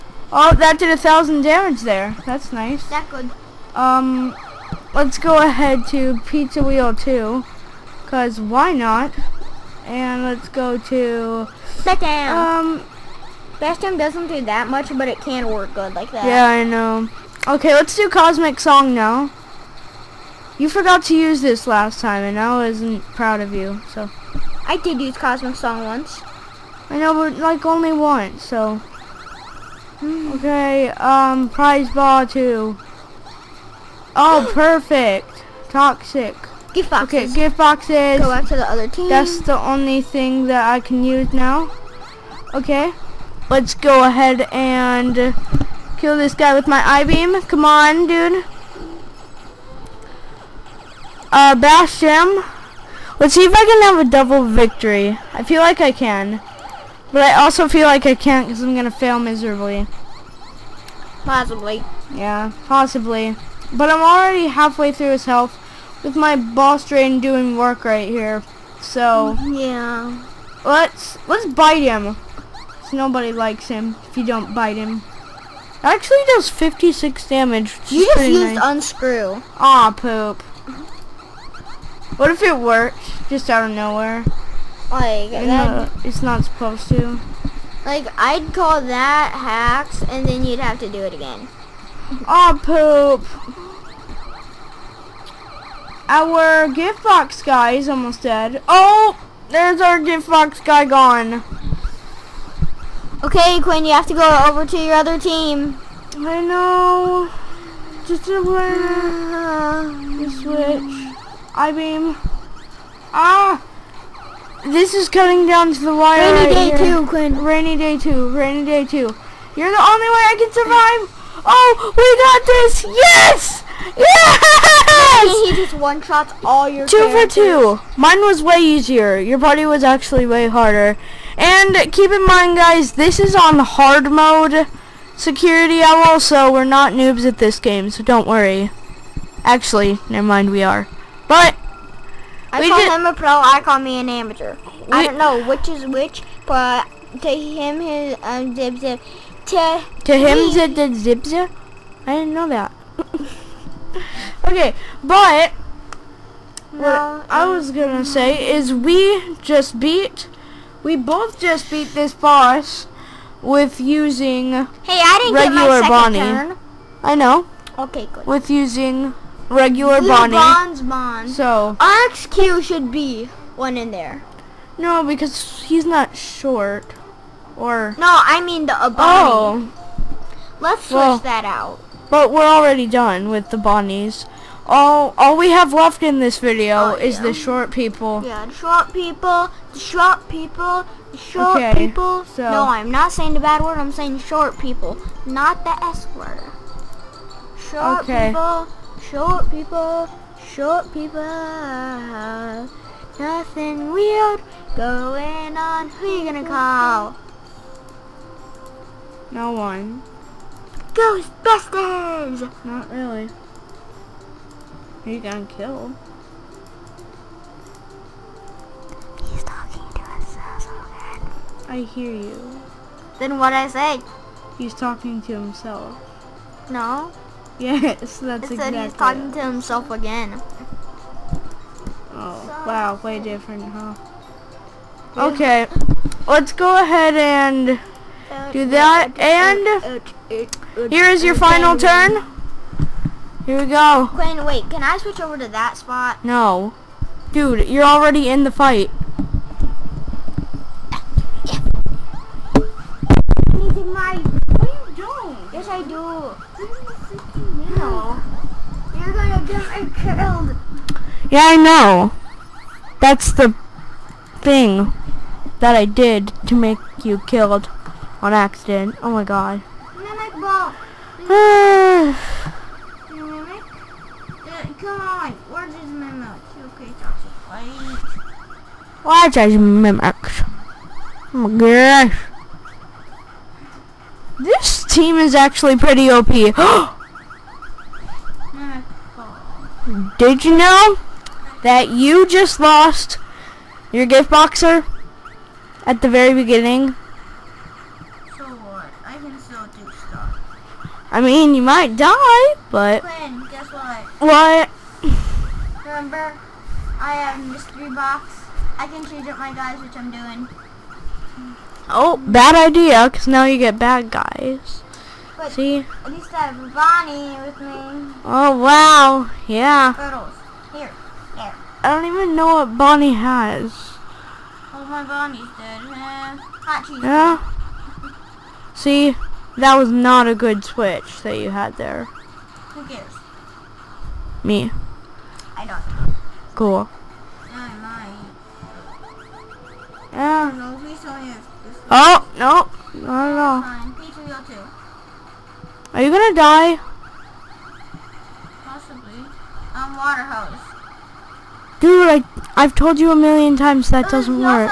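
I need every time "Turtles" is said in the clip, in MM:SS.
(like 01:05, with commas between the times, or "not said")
05:19.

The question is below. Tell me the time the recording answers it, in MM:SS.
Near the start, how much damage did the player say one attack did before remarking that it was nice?
00:00.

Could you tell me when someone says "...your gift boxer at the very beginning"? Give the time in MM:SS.
04:53.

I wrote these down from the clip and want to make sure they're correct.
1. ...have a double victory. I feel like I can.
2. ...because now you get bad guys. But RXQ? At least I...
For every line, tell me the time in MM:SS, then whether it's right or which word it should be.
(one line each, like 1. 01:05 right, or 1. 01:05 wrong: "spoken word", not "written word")
1. 00:53 right
2. 05:13 wrong: "See", not "RXQ".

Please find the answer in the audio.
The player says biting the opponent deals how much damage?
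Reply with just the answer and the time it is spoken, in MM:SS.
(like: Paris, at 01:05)
56, at 01:16.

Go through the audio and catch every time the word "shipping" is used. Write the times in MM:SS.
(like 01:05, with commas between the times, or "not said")
not said.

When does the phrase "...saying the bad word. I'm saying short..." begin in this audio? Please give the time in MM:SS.
03:13.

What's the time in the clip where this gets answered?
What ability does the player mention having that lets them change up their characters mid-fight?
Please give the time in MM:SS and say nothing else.
05:07.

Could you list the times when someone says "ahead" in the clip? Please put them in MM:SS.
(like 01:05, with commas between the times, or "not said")
00:05, 00:44, 03:56.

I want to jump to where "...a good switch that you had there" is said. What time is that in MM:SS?
05:30.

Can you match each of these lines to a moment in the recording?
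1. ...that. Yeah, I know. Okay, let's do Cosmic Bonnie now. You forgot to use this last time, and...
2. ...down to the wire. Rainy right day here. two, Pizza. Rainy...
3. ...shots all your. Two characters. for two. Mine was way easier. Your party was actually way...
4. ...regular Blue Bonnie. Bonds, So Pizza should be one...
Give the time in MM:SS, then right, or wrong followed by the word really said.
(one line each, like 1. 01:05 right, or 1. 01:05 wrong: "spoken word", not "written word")
1. 00:16 wrong: "Song", not "Bonnie"
2. 01:55 wrong: "Quinn", not "Pizza"
3. 02:06 right
4. 02:49 wrong: "RXQ", not "Pizza".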